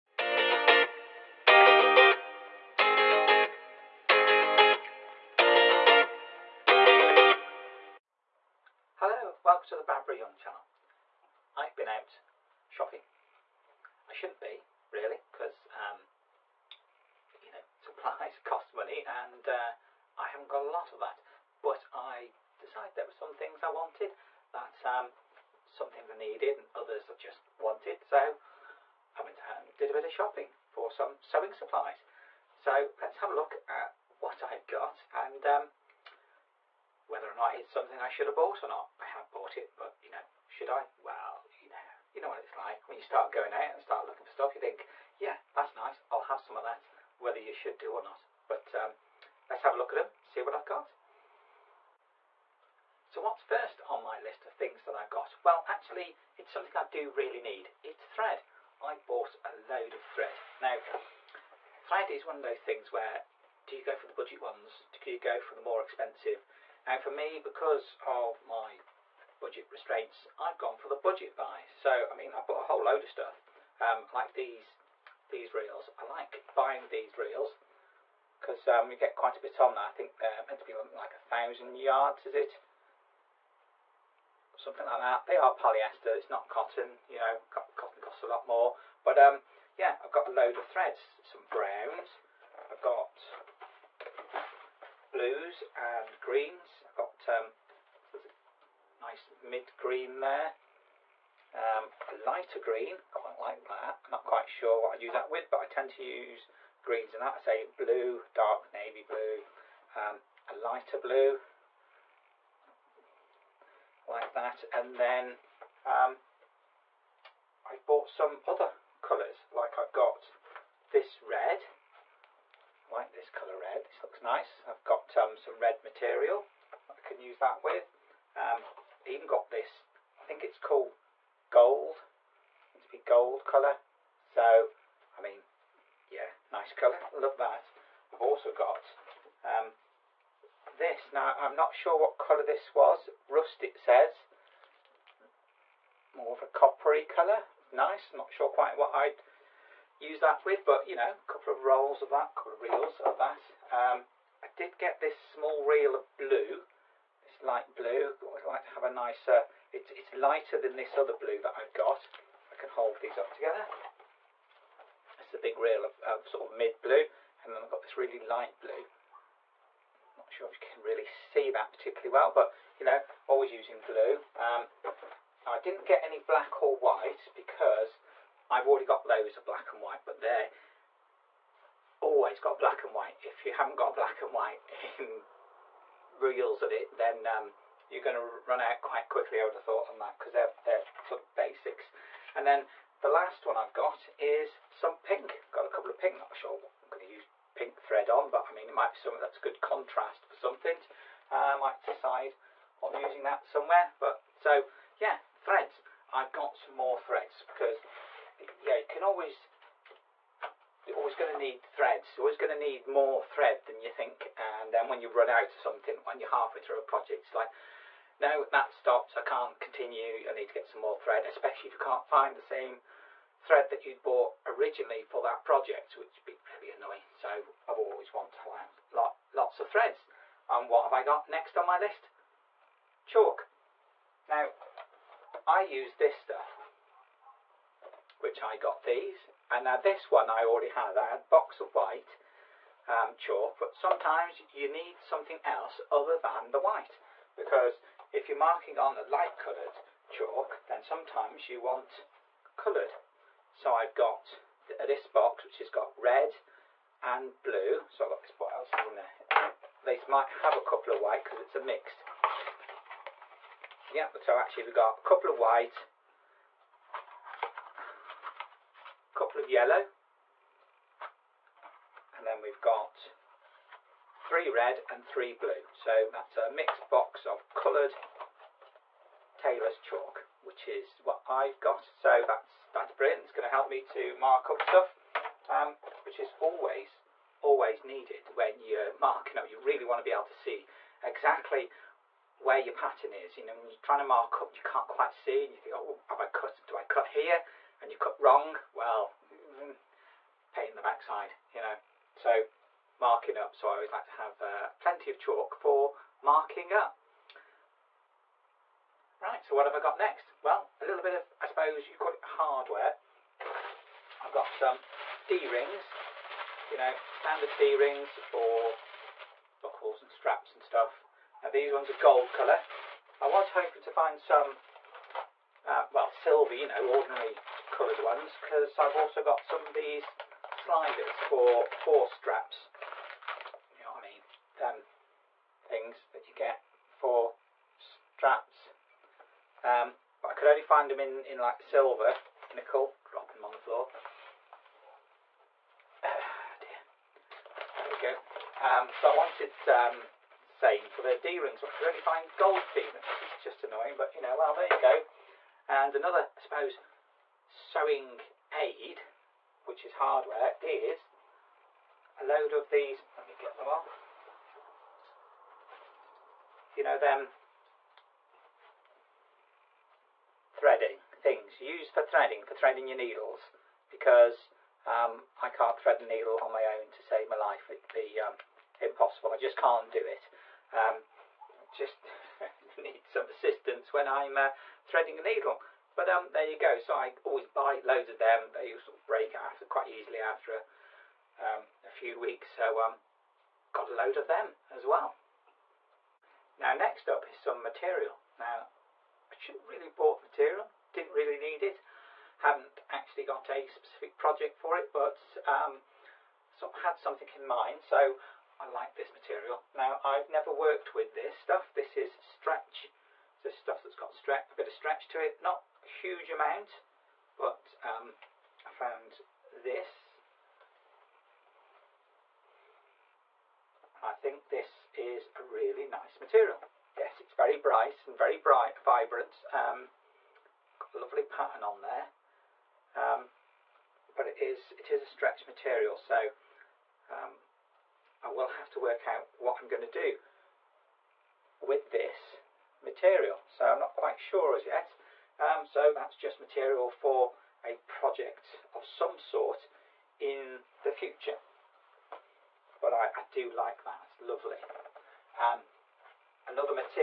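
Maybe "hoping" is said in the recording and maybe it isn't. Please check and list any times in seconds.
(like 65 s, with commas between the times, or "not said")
323 s.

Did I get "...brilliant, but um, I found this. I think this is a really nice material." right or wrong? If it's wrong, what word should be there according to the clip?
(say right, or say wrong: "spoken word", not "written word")
wrong: "amount", not "brilliant".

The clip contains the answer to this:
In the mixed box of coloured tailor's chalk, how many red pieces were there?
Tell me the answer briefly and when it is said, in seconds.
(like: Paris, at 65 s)
3, at 274 s.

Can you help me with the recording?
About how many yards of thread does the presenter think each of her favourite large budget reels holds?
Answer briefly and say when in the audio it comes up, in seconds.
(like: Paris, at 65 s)
1000 yards, at 81 s.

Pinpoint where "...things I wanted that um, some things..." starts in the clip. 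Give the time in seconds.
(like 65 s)
23 s.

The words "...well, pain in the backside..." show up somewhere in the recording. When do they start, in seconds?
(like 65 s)
298 s.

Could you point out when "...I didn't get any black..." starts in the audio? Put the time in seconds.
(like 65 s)
175 s.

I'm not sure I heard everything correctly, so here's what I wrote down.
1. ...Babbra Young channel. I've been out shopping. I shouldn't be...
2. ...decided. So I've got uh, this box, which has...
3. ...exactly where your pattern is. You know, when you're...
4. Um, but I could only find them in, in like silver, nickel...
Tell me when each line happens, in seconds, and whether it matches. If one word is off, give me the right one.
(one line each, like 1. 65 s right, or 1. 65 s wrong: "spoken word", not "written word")
1. 9 s right
2. 252 s wrong: "coloured", not "decided"
3. 291 s right
4. 339 s right.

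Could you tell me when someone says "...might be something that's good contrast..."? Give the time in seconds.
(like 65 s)
198 s.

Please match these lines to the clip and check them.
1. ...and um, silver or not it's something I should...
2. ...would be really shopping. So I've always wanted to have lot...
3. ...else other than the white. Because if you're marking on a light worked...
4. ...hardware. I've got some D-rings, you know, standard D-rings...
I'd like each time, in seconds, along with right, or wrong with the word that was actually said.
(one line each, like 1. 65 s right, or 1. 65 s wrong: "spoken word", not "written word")
1. 35 s wrong: "whether", not "silver"
2. 226 s wrong: "annoying", not "shopping"
3. 245 s wrong: "coloured", not "worked"
4. 312 s right.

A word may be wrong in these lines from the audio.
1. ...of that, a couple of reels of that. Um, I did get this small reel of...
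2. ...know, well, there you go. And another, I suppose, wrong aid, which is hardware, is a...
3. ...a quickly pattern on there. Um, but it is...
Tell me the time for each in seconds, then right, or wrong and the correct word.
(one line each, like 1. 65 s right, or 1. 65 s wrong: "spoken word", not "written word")
1. 152 s right
2. 354 s wrong: "sewing", not "wrong"
3. 430 s wrong: "lovely", not "quickly".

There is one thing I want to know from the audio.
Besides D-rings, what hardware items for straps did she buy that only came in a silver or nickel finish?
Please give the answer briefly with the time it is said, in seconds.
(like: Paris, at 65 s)
Sliders, at 330 s.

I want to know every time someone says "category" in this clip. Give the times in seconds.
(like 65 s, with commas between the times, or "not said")
not said.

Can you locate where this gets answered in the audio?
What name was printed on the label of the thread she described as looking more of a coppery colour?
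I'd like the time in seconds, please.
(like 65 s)
143 s.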